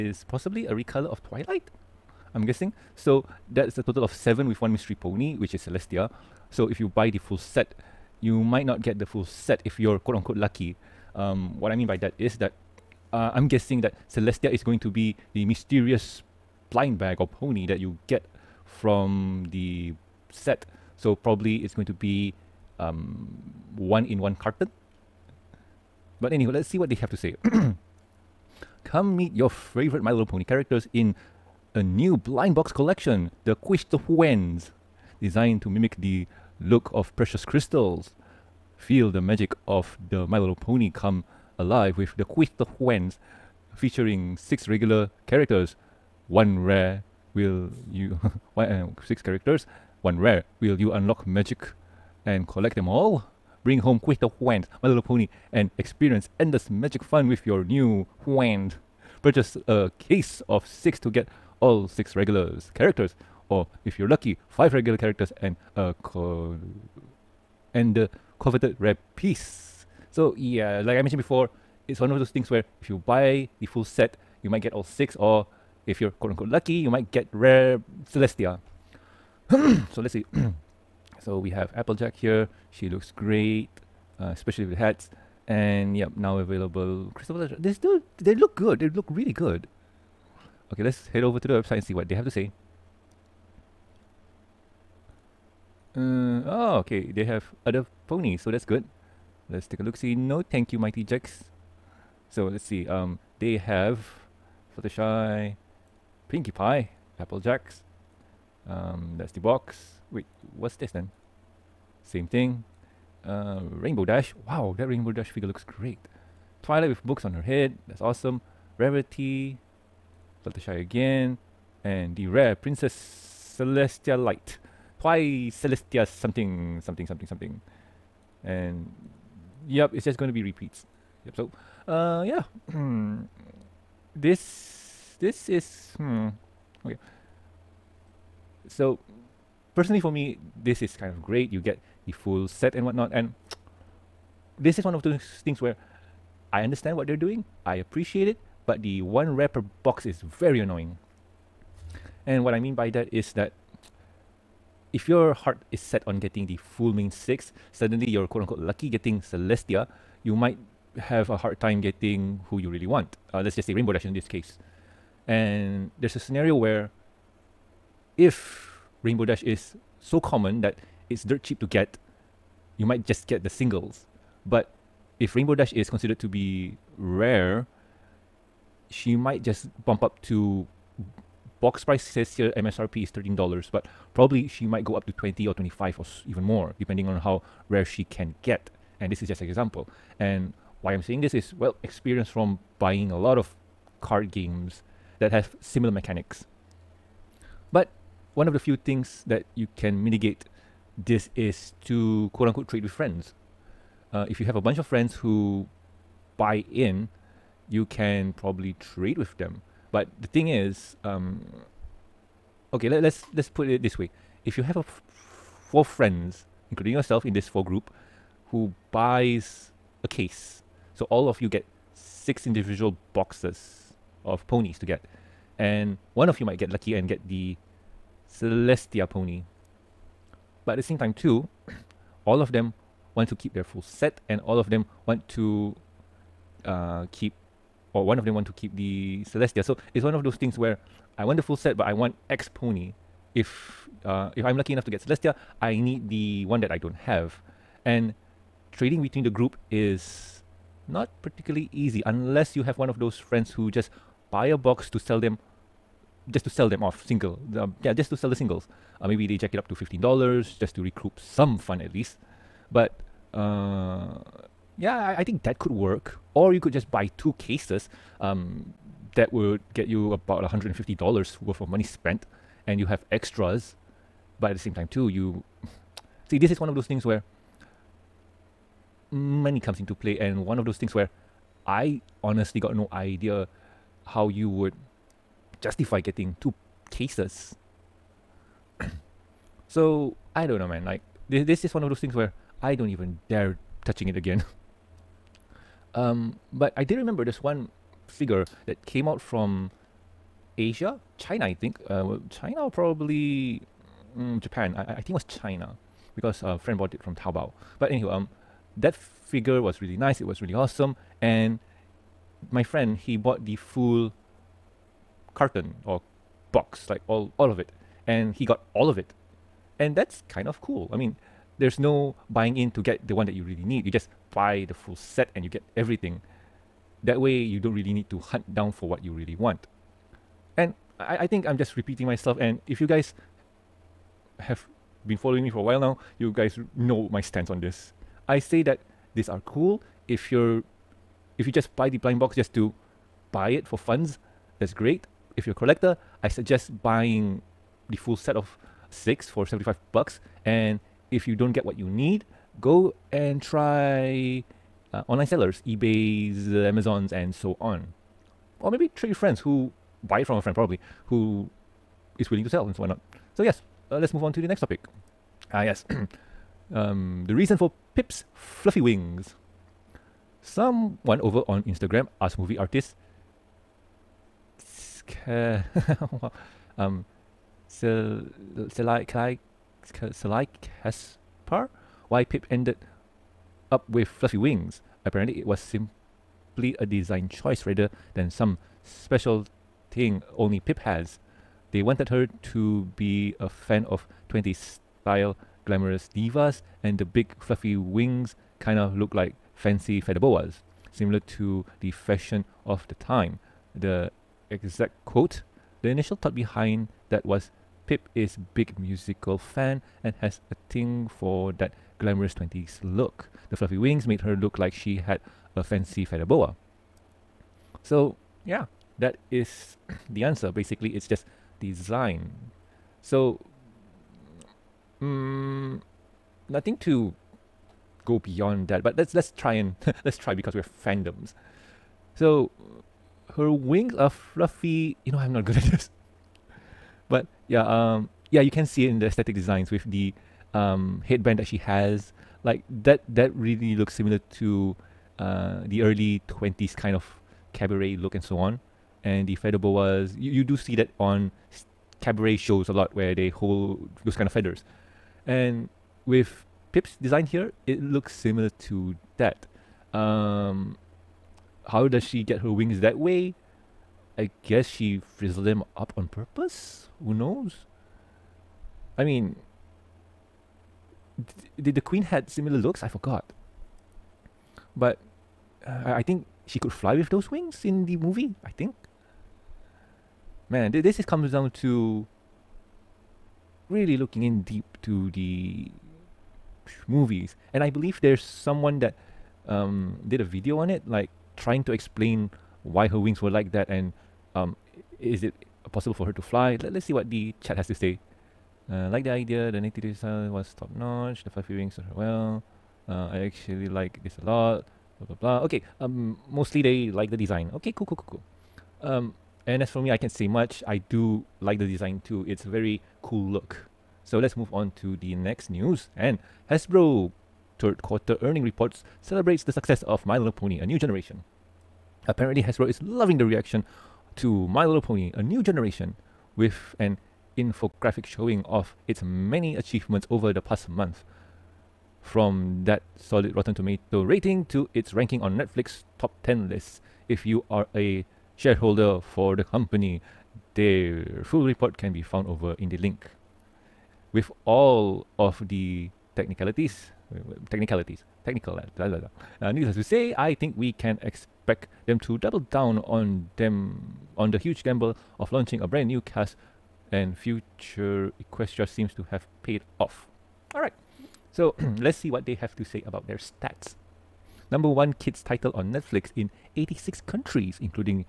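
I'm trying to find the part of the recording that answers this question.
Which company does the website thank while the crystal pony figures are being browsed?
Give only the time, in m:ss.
1:40.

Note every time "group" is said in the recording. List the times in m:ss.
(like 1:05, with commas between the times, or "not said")
3:37, 4:09.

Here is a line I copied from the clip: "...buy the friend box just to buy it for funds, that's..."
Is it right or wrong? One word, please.
wrong.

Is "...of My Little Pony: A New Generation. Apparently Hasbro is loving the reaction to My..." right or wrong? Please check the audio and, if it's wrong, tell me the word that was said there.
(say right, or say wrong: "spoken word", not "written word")
right.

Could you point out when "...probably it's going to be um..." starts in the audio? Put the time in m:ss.
0:21.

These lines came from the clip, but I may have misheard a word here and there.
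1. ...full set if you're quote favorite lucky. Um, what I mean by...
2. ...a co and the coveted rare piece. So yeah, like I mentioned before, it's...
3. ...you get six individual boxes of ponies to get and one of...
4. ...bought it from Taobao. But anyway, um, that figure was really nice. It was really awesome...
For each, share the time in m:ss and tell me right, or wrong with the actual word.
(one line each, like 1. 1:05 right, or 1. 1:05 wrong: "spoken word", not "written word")
1. 0:09 wrong: "unquote", not "favorite"
2. 1:05 right
3. 3:41 right
4. 5:06 right.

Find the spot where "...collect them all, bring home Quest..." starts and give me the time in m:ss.
0:52.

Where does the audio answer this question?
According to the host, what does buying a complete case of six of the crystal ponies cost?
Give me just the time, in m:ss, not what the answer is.
5:49.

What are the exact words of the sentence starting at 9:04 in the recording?
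With all of the technicalities, technicalities, technical, blah, blah, blah.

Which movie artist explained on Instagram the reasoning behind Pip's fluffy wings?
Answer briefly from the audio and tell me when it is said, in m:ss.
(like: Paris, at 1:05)
Selai Kaspar, at 6:17.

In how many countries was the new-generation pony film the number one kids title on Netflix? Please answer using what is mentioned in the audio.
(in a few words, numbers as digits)
86.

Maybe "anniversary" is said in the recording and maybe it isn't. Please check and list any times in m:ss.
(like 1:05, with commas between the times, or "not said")
not said.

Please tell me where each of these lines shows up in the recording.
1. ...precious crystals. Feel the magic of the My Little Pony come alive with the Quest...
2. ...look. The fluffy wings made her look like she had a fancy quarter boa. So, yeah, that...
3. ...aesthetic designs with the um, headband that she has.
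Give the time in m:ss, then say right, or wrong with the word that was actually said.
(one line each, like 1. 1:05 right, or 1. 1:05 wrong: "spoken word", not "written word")
1. 0:37 right
2. 6:52 wrong: "feather", not "quarter"
3. 7:19 right.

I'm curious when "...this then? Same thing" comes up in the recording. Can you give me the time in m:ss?
1:50.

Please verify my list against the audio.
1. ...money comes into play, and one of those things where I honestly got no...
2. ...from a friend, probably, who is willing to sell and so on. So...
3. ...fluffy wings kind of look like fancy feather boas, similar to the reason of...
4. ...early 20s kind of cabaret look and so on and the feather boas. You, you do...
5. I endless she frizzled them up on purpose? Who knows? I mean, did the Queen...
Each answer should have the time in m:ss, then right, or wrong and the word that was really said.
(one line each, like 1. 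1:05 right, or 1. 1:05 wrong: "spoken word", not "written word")
1. 4:39 right
2. 6:00 right
3. 6:37 wrong: "fashion", not "reason"
4. 7:25 right
5. 7:44 wrong: "guess", not "endless".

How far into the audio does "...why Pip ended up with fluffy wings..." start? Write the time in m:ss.
6:22.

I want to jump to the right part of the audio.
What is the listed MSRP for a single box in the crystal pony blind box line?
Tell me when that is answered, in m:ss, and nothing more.
3:02.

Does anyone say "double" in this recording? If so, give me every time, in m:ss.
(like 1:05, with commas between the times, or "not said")
9:12.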